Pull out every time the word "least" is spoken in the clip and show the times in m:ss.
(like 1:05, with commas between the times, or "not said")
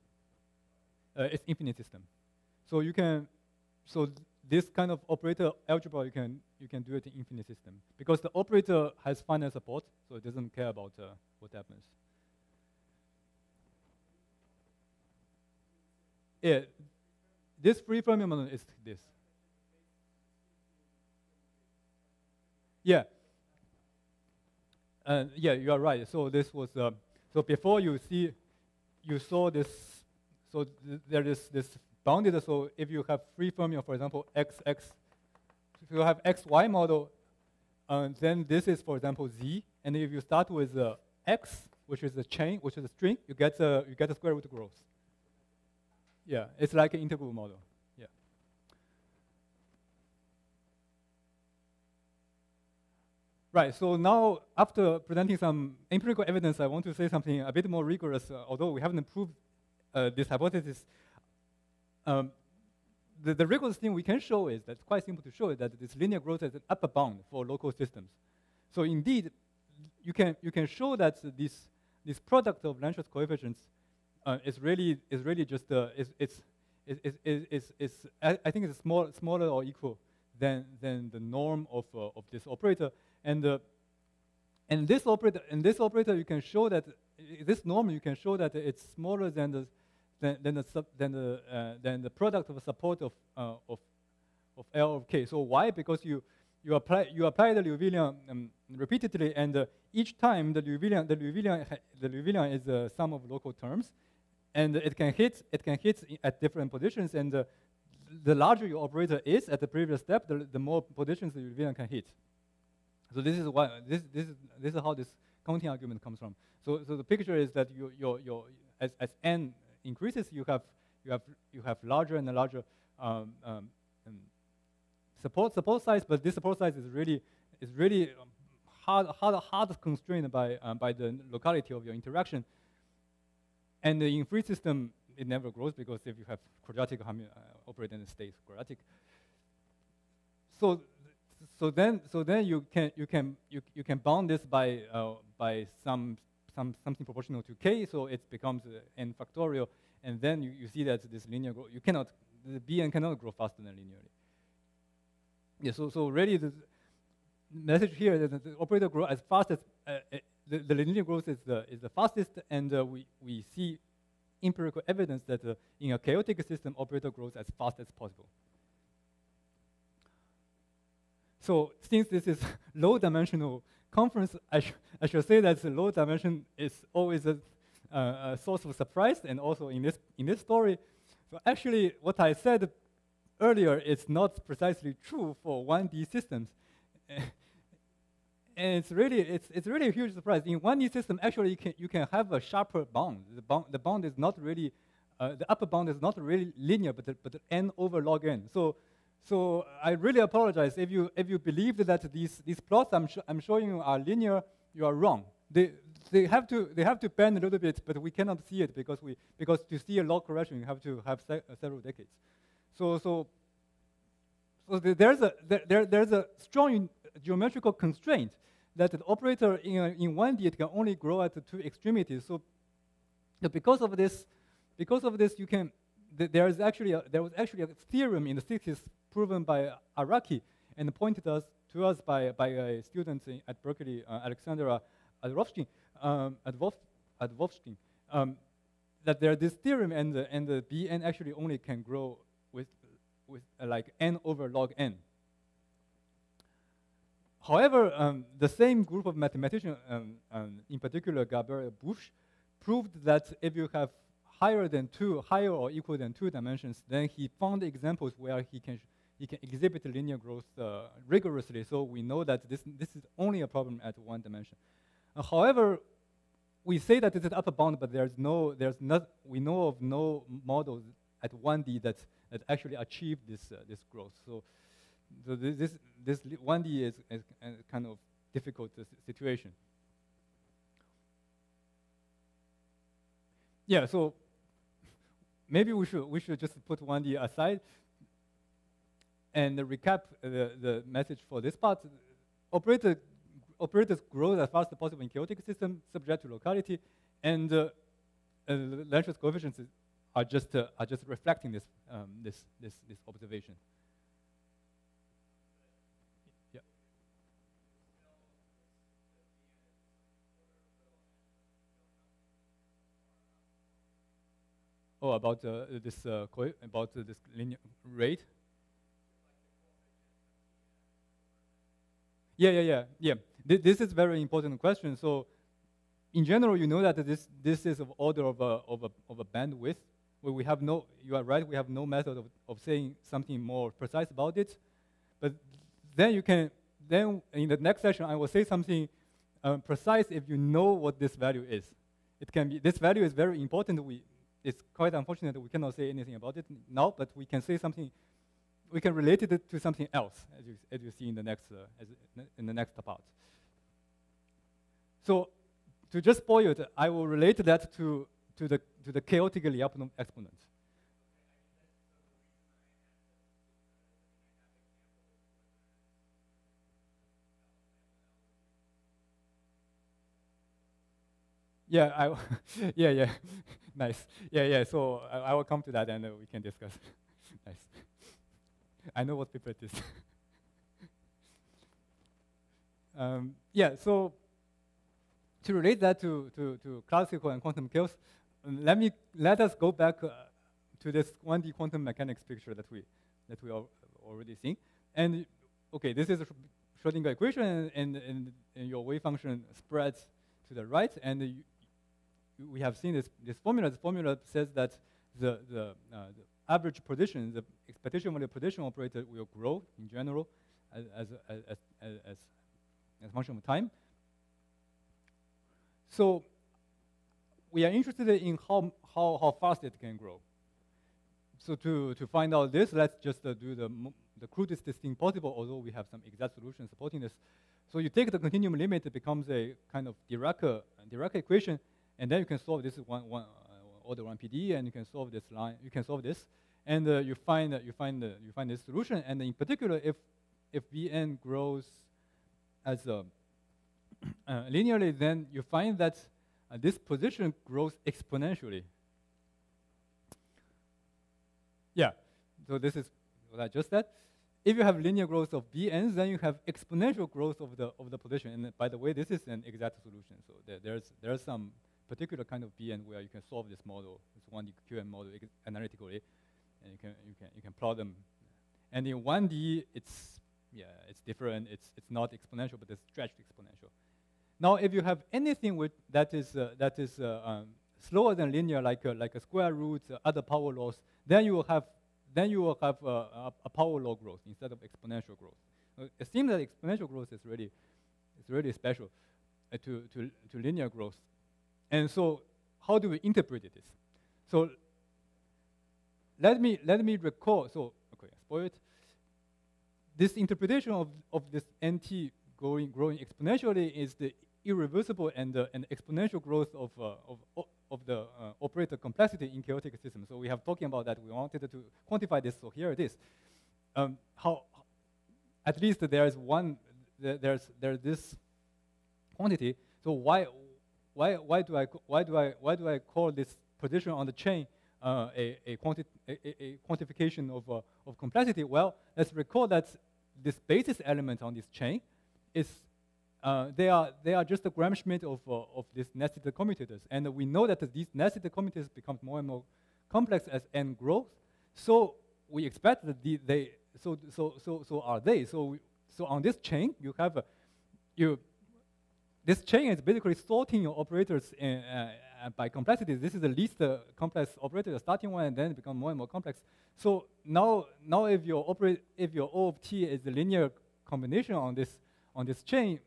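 8:35, 9:13.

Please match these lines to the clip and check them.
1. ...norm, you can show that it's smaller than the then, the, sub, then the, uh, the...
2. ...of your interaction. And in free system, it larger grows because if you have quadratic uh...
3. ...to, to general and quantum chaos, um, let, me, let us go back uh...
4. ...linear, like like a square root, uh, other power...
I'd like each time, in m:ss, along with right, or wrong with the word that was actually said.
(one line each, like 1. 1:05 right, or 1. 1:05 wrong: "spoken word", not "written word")
1. 1:27 right
2. 2:11 wrong: "never", not "larger"
3. 6:26 wrong: "classical", not "general"
4. 7:58 right.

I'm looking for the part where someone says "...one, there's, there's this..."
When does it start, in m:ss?
8:36.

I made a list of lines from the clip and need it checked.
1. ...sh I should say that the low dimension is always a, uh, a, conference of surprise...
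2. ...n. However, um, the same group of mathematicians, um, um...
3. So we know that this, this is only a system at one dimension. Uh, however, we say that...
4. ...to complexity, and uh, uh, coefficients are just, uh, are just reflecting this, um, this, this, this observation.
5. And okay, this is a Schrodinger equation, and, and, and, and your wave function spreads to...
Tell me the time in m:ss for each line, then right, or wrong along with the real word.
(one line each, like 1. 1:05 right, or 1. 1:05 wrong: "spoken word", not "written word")
1. 2:54 wrong: "source", not "conference"
2. 4:04 right
3. 4:21 wrong: "problem", not "system"
4. 4:56 wrong: "locality", not "complexity"
5. 6:34 right.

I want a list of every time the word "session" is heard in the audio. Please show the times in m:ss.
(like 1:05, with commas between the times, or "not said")
5:37.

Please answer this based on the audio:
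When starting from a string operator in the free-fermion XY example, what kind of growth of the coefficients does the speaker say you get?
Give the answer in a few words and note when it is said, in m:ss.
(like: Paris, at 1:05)
square root growth, at 0:44.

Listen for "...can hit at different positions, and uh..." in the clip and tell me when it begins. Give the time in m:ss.
1:45.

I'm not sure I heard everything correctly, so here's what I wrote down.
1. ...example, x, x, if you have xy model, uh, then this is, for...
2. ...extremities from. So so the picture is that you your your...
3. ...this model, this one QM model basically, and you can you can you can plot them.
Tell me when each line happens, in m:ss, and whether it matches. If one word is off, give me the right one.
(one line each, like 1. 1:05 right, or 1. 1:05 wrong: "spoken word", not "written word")
1. 0:33 right
2. 1:56 wrong: "comes", not "extremities"
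3. 7:43 wrong: "analytically", not "basically".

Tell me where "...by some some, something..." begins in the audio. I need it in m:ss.
2:25.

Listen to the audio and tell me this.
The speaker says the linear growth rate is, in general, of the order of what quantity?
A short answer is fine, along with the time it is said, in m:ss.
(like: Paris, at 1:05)
bandwidth, at 5:29.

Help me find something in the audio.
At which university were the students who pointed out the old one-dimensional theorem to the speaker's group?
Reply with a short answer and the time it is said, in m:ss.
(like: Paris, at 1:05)
Berkeley, at 3:53.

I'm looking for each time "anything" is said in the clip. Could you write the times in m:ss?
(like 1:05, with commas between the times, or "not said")
5:45, 7:55.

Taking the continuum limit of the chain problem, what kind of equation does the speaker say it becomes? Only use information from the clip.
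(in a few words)
Dirac equation.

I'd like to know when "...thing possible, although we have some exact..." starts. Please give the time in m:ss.
7:04.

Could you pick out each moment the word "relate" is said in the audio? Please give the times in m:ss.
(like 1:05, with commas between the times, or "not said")
5:48, 5:57, 6:25.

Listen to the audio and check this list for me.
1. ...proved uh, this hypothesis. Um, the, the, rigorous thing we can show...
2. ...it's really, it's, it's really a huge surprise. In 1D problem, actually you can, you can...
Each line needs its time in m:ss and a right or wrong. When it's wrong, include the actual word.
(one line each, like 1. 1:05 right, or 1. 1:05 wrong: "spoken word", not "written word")
1. 0:59 right
2. 3:08 wrong: "system", not "problem".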